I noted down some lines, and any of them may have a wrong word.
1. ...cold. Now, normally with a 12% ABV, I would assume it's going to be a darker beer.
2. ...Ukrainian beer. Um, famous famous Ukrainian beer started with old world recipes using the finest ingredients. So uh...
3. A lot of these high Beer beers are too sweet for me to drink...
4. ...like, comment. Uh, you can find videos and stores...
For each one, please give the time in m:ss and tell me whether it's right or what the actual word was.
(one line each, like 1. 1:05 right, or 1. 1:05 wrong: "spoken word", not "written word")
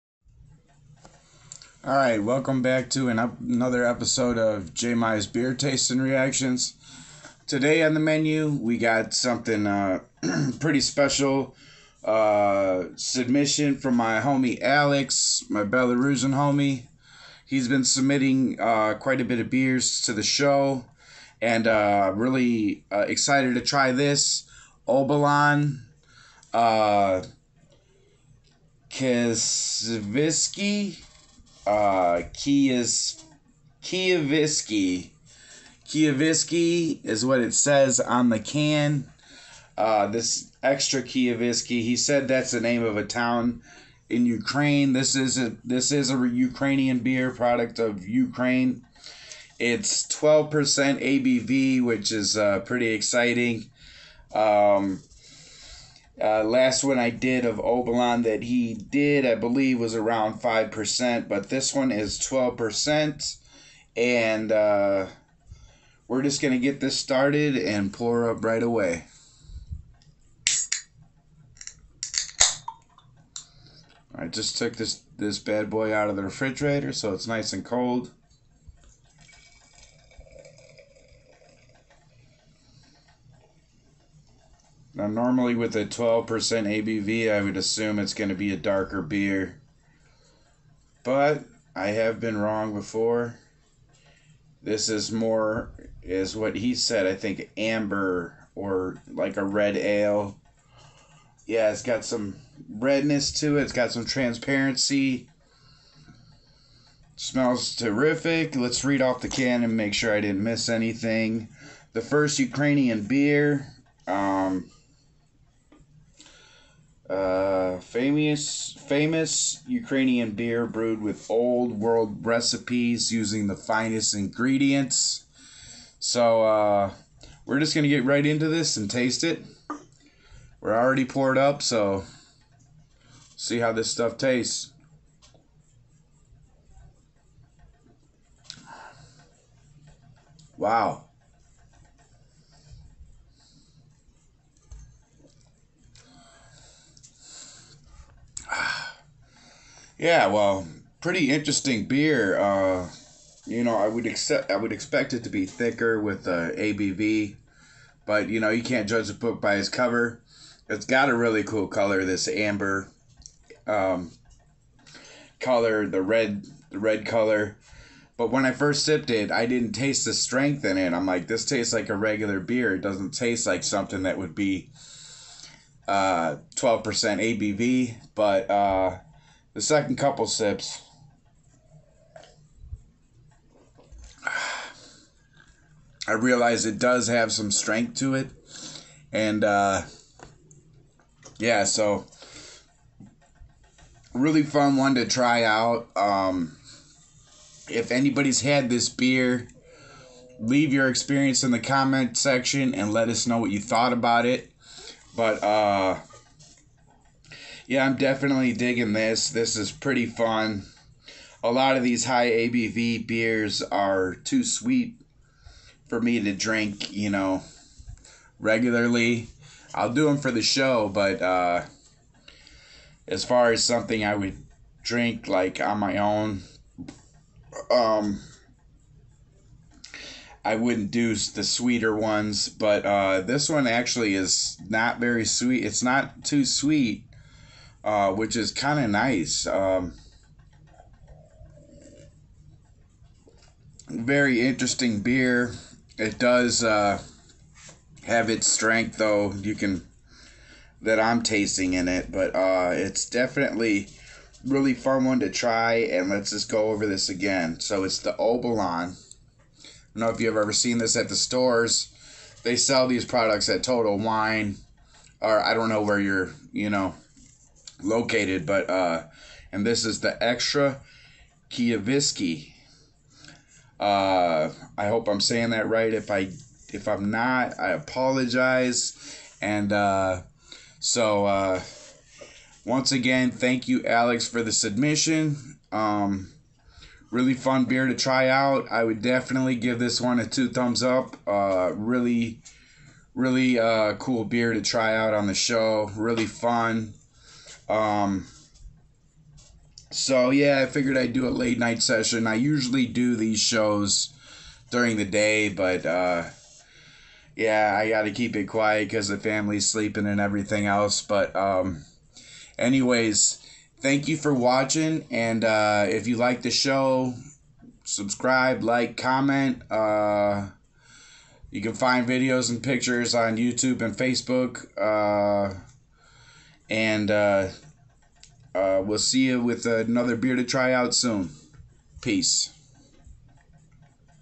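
1. 1:17 right
2. 1:52 wrong: "brewed", not "started"
3. 3:31 wrong: "ABV", not "Beer"
4. 5:18 wrong: "pictures", not "stores".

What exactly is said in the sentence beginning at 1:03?
And uh, we're just going to get this started and pour up right away.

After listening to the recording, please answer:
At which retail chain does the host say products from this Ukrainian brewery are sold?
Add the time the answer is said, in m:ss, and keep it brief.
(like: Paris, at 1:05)
Total Wine, at 4:23.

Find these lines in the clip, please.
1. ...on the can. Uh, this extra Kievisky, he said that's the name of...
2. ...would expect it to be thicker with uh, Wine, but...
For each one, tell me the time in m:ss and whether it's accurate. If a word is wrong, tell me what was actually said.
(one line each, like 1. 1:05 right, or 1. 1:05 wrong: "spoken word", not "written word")
1. 0:37 right
2. 2:34 wrong: "ABV", not "Wine".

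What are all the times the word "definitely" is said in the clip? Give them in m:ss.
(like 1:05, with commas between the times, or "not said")
3:27, 4:13, 4:49.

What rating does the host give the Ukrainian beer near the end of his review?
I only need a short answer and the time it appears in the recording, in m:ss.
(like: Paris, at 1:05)
Two thumbs up, at 4:50.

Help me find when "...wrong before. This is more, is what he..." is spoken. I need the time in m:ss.
1:32.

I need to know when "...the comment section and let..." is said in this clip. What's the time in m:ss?
3:21.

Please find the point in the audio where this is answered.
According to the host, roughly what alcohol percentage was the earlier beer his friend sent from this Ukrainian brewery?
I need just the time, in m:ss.
1:00.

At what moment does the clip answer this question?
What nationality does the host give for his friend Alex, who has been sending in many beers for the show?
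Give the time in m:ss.
0:15.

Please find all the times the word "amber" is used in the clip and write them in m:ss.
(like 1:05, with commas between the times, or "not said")
1:37, 2:42.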